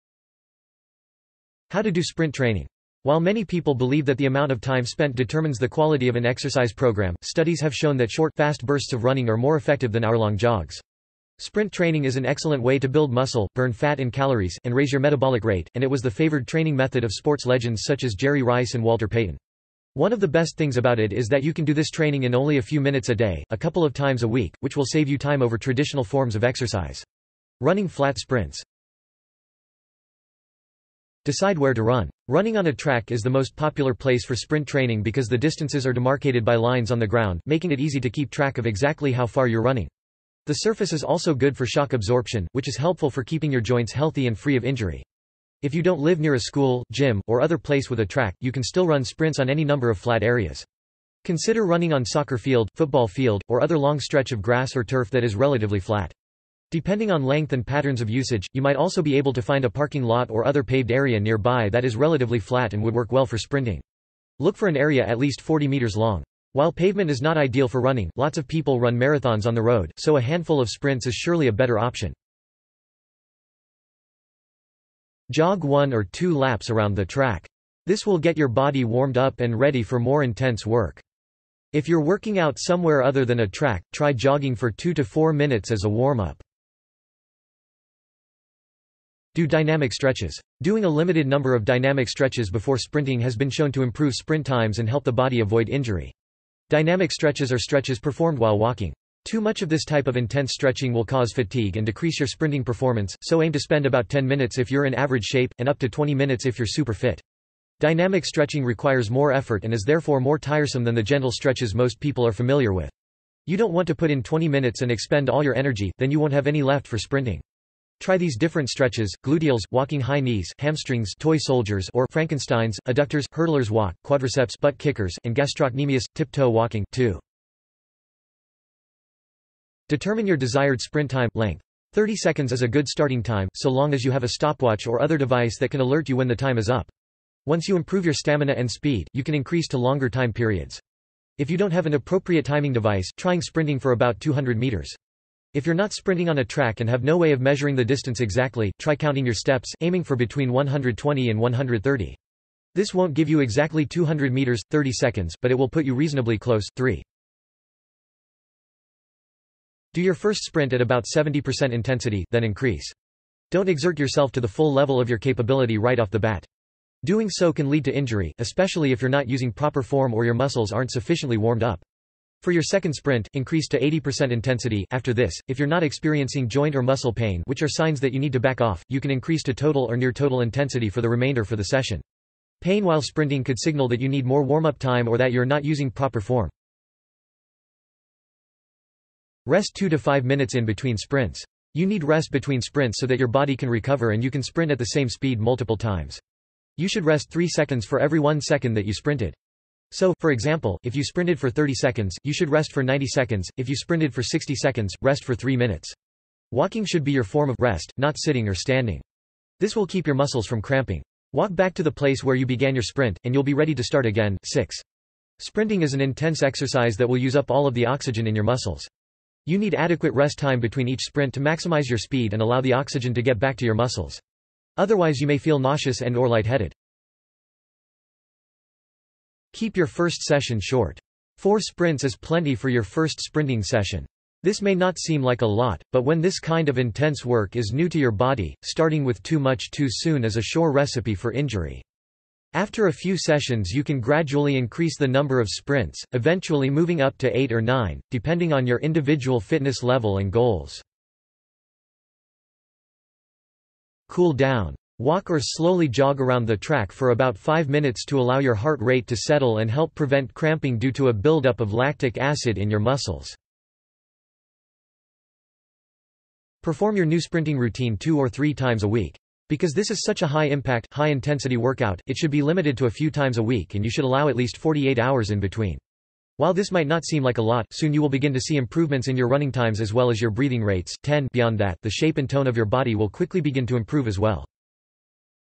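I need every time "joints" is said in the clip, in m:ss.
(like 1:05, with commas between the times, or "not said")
0:43, 2:56.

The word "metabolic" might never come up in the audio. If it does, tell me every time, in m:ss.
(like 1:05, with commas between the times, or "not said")
0:14.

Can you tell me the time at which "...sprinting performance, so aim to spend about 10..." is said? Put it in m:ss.
1:42.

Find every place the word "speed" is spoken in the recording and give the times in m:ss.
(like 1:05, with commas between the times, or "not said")
2:18, 3:15, 3:41.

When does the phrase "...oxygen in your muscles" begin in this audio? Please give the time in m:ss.
3:37.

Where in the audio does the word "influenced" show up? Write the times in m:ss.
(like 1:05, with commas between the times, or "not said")
not said.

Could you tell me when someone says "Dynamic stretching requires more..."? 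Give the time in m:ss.
1:47.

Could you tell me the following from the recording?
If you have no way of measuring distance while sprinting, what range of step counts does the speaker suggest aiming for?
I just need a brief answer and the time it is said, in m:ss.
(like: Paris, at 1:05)
120 to 130, at 2:30.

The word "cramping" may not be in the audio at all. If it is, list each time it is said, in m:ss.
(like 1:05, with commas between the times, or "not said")
3:30, 4:20.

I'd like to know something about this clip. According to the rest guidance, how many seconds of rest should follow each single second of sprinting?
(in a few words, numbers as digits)
3 seconds.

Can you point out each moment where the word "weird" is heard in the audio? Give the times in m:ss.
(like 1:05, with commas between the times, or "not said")
not said.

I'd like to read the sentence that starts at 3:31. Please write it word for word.
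Walk back to the place where you began your sprint, and you'll be ready to start again.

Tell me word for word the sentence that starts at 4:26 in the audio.
Perform your new sprinting routine two or three times a week.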